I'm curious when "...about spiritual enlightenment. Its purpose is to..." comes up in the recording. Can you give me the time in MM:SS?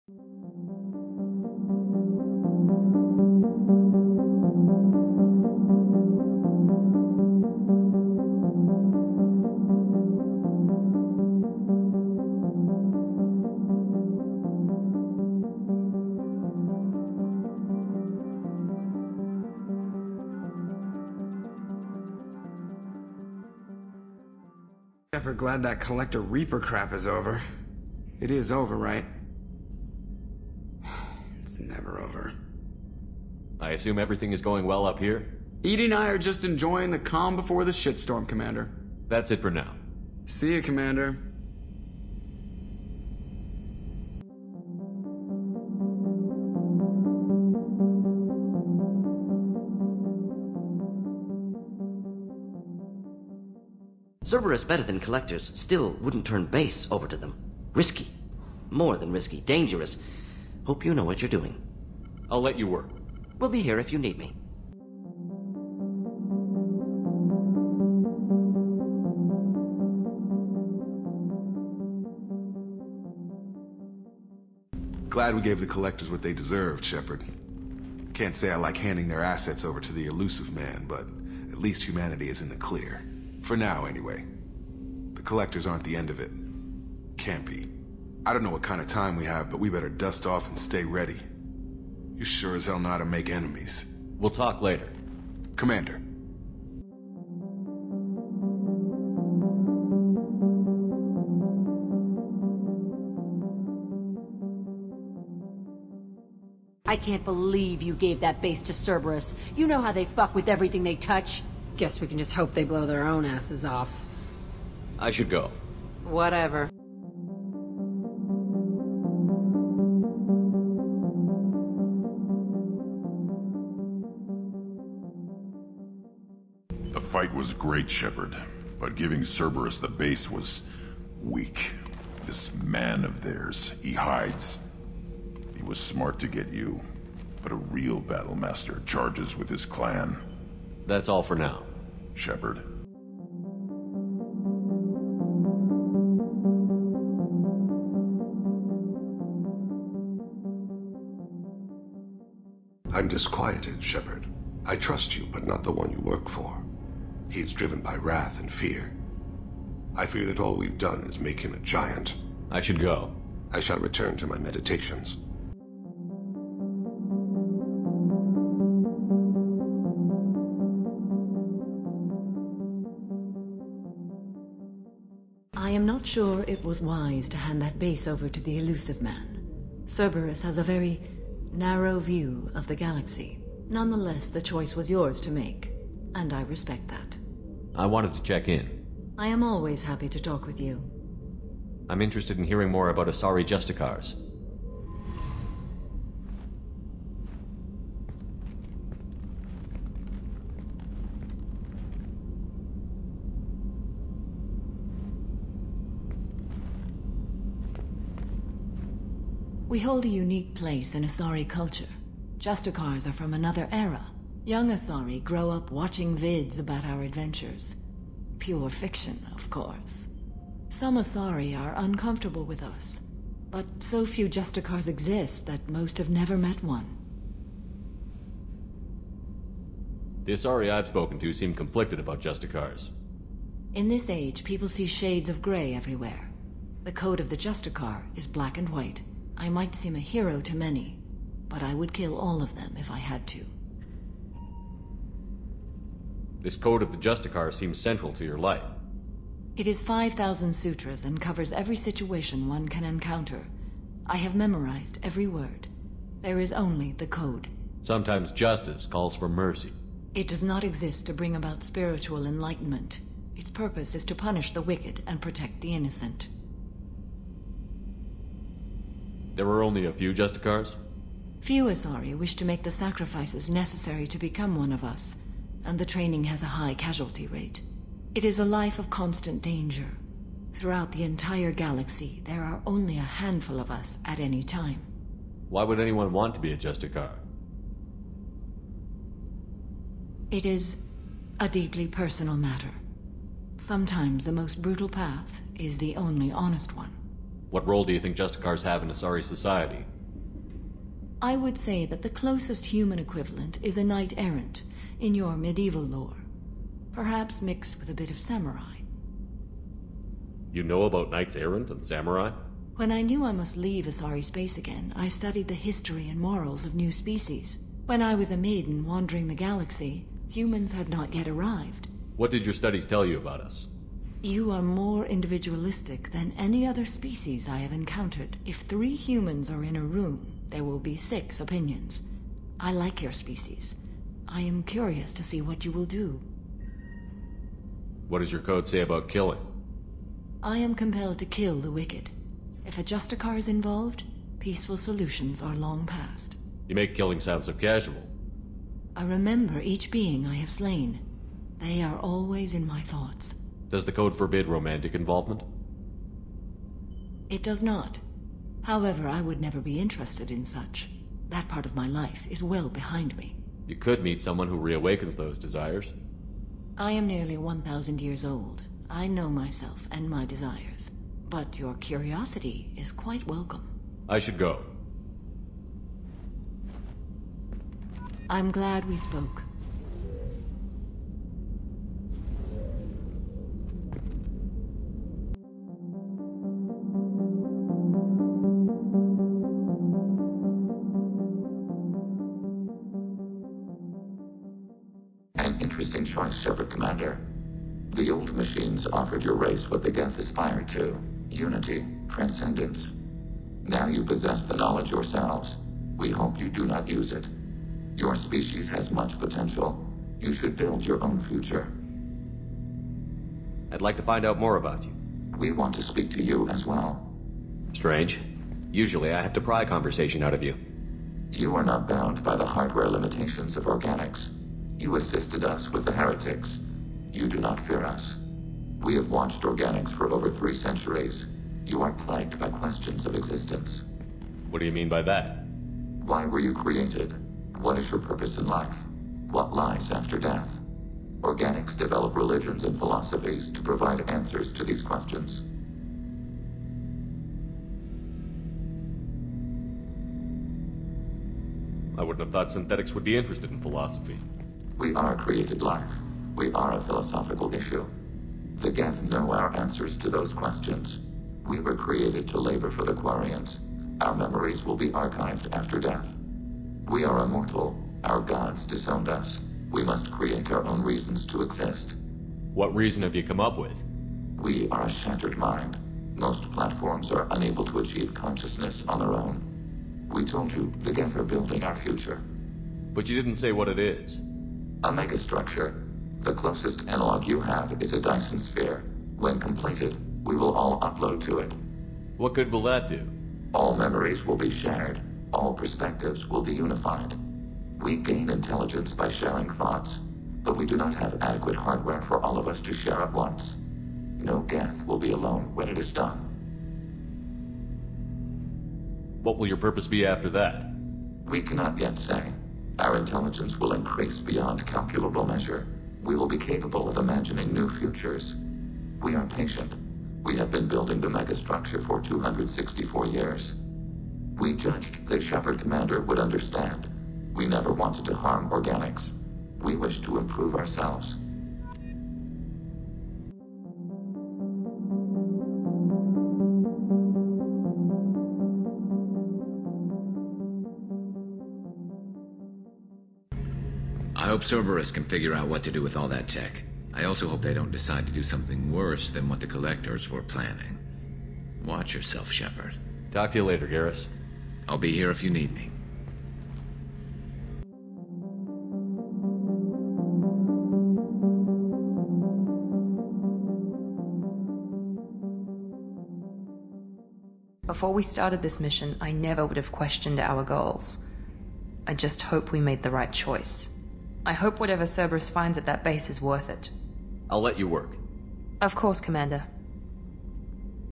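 04:21.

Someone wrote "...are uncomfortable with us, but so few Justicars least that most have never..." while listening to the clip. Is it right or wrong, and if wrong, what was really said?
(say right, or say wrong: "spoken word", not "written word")
wrong: "exist", not "least".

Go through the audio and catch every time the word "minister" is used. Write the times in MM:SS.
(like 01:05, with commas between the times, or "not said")
not said.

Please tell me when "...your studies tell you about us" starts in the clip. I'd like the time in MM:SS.
05:22.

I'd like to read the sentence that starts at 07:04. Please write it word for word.
You assisted us with the heretics.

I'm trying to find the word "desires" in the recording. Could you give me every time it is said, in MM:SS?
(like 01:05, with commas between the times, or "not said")
06:05, 06:10.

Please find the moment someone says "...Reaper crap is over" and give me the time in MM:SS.
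00:26.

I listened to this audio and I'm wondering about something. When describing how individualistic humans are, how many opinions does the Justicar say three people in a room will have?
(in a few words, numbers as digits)
6.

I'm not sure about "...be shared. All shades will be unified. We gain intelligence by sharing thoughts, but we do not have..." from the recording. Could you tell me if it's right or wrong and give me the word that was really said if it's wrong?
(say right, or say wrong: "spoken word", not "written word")
wrong: "perspectives", not "shades".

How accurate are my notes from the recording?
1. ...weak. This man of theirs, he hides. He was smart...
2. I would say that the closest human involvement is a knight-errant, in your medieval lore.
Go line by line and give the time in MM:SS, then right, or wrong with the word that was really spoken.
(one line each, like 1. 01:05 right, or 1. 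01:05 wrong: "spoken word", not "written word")
1. 02:11 right
2. 05:01 wrong: "equivalent", not "involvement".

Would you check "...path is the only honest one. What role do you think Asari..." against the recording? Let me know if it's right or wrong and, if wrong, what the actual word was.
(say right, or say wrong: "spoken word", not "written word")
wrong: "Justicars", not "Asari".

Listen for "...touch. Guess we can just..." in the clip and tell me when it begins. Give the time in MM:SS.
01:50.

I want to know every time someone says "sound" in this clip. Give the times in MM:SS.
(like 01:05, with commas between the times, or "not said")
05:47.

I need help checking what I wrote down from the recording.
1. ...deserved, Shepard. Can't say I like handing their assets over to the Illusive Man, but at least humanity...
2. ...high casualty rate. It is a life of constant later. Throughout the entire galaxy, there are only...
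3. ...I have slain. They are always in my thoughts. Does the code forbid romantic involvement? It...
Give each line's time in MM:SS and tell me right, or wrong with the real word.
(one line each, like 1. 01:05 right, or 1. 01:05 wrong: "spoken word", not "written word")
1. 01:16 right
2. 04:36 wrong: "danger", not "later"
3. 05:50 right.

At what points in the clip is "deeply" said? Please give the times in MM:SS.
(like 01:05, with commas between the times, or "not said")
04:51.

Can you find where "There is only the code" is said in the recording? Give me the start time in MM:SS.
04:16.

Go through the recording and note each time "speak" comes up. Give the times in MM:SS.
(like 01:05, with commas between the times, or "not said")
06:55.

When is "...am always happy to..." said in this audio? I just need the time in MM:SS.
03:09.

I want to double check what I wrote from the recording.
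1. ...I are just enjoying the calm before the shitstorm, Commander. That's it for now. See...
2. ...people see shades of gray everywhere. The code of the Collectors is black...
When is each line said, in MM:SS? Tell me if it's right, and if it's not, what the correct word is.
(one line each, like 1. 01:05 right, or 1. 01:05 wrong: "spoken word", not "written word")
1. 00:35 right
2. 03:54 wrong: "Justicar", not "Collectors".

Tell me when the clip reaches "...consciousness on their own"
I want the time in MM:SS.
07:58.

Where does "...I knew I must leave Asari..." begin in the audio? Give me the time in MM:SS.
05:12.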